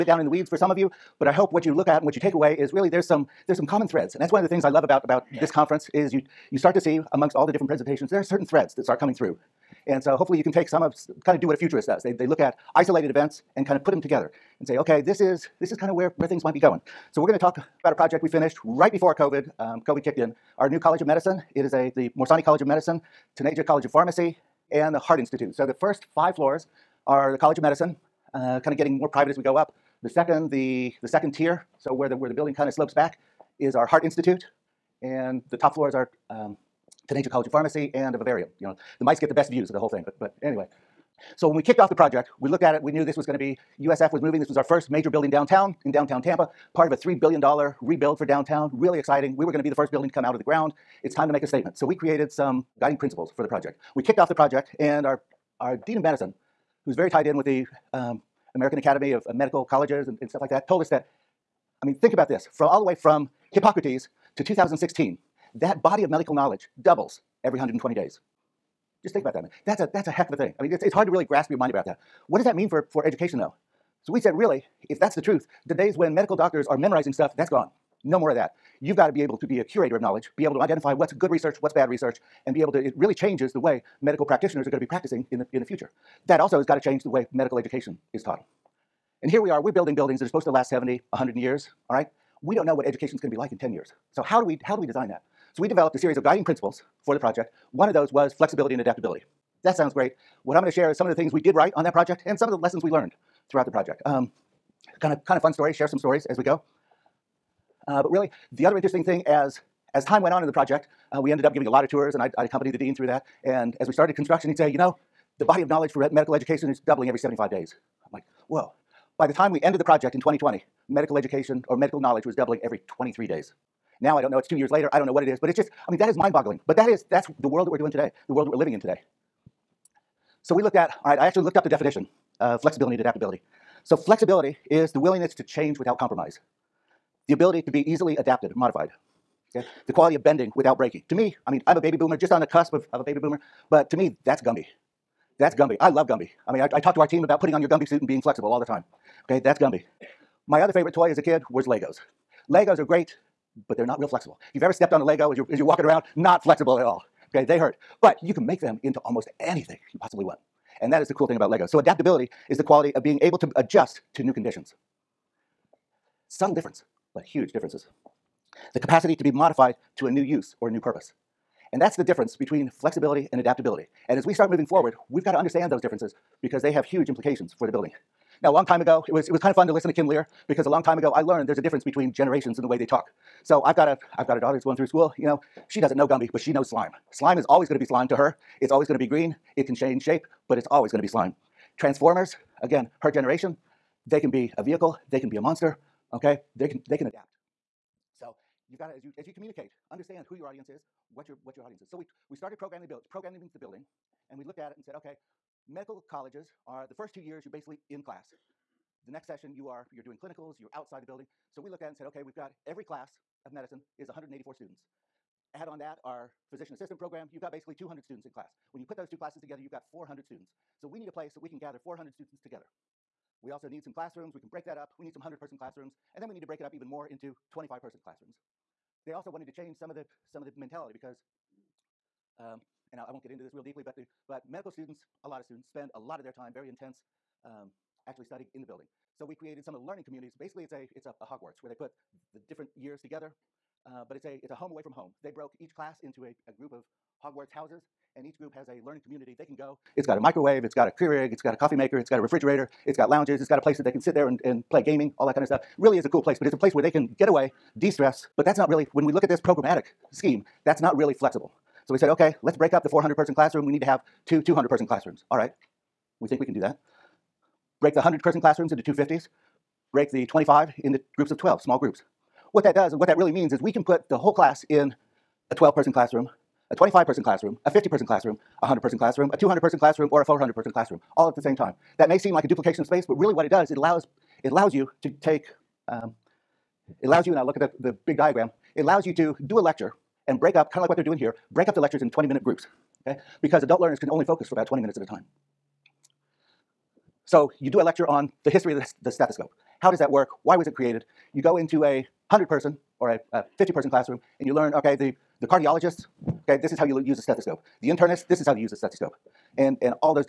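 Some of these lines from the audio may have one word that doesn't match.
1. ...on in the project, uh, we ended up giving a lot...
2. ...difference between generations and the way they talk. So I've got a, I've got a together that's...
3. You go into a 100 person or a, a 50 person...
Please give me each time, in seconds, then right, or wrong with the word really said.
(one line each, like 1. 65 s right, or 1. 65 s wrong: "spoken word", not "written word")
1. 110 s right
2. 181 s wrong: "daughter", not "together"
3. 301 s right.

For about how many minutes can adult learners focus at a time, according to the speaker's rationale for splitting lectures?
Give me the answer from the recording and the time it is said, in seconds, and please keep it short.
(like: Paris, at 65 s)
20 minutes, at 294 s.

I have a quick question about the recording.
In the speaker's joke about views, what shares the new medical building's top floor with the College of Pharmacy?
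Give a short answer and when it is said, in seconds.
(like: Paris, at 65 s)
vivarium, at 38 s.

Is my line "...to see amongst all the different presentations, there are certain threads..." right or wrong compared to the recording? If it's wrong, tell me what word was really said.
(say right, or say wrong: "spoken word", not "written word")
right.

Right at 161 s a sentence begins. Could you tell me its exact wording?
So adaptability is the quality of being able to adjust to new conditions.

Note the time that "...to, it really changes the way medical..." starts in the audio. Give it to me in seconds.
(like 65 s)
82 s.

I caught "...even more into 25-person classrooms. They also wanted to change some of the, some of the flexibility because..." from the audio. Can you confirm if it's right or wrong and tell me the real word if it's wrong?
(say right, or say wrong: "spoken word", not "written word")
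wrong: "mentality", not "flexibility".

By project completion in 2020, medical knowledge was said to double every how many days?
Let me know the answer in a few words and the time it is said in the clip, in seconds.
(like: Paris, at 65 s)
23 days, at 122 s.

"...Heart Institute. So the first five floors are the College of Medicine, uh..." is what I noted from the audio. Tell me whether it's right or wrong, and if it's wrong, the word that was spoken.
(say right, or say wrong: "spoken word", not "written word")
right.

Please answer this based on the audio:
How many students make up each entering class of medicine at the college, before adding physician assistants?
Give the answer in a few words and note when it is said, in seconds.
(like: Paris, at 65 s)
184, at 214 s.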